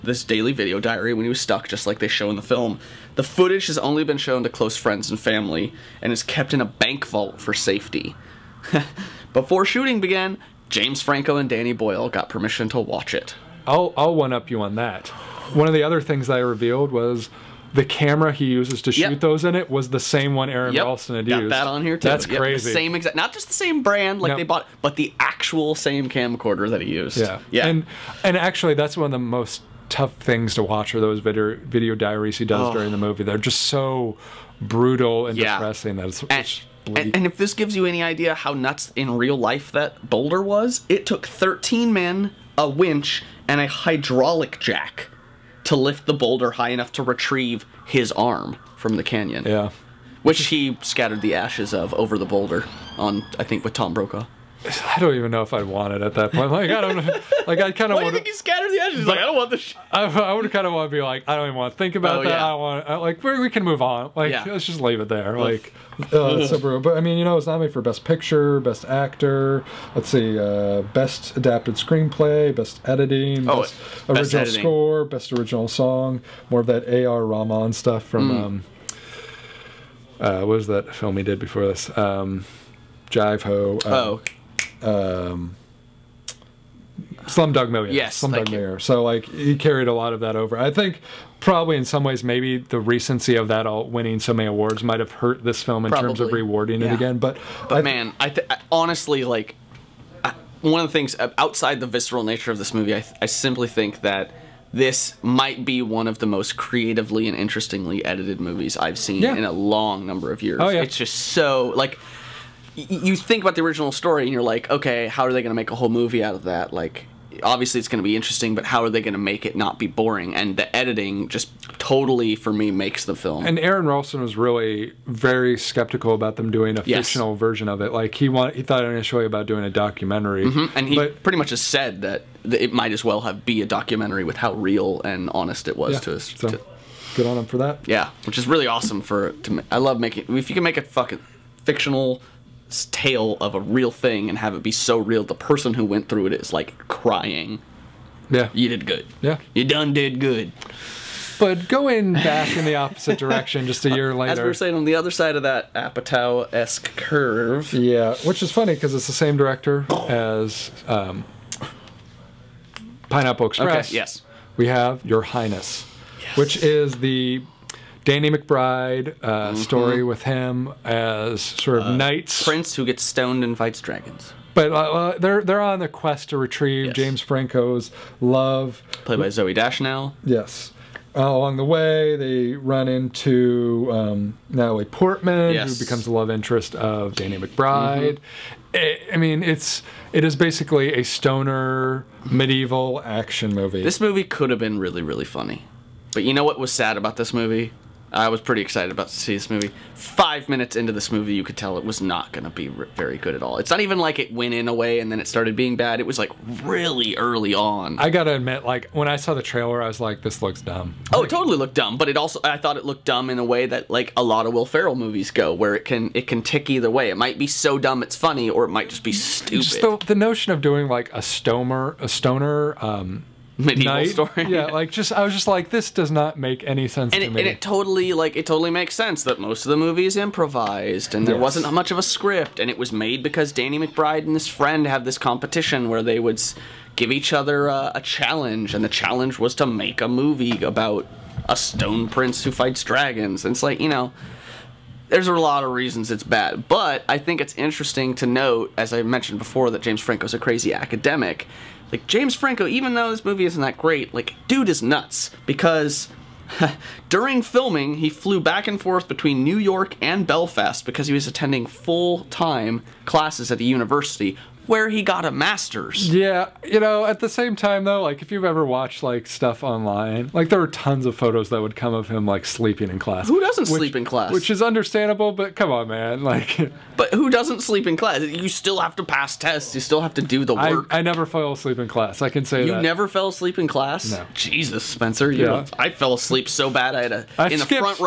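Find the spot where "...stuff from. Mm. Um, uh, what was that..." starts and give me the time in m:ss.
1:17.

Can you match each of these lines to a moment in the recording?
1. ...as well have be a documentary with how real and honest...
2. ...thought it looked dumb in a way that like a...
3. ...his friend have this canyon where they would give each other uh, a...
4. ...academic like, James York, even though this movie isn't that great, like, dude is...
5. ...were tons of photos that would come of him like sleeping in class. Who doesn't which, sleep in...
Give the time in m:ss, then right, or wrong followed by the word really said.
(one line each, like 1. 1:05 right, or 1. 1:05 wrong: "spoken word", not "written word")
1. 2:12 right
2. 3:32 right
3. 3:54 wrong: "competition", not "canyon"
4. 4:10 wrong: "Franco", not "York"
5. 4:30 right.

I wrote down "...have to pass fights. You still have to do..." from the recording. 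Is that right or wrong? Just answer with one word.
wrong.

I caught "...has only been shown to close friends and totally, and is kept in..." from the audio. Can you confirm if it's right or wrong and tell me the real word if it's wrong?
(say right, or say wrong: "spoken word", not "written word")
wrong: "family", not "totally".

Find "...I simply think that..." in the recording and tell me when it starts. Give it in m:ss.
1:43.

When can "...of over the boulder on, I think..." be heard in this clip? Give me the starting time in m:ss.
0:51.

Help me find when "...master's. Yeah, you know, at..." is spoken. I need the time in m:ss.
4:25.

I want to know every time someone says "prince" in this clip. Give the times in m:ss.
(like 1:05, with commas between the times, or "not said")
2:52, 4:02.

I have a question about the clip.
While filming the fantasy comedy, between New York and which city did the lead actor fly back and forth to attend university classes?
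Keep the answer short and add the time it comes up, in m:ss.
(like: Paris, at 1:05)
Belfast, at 4:20.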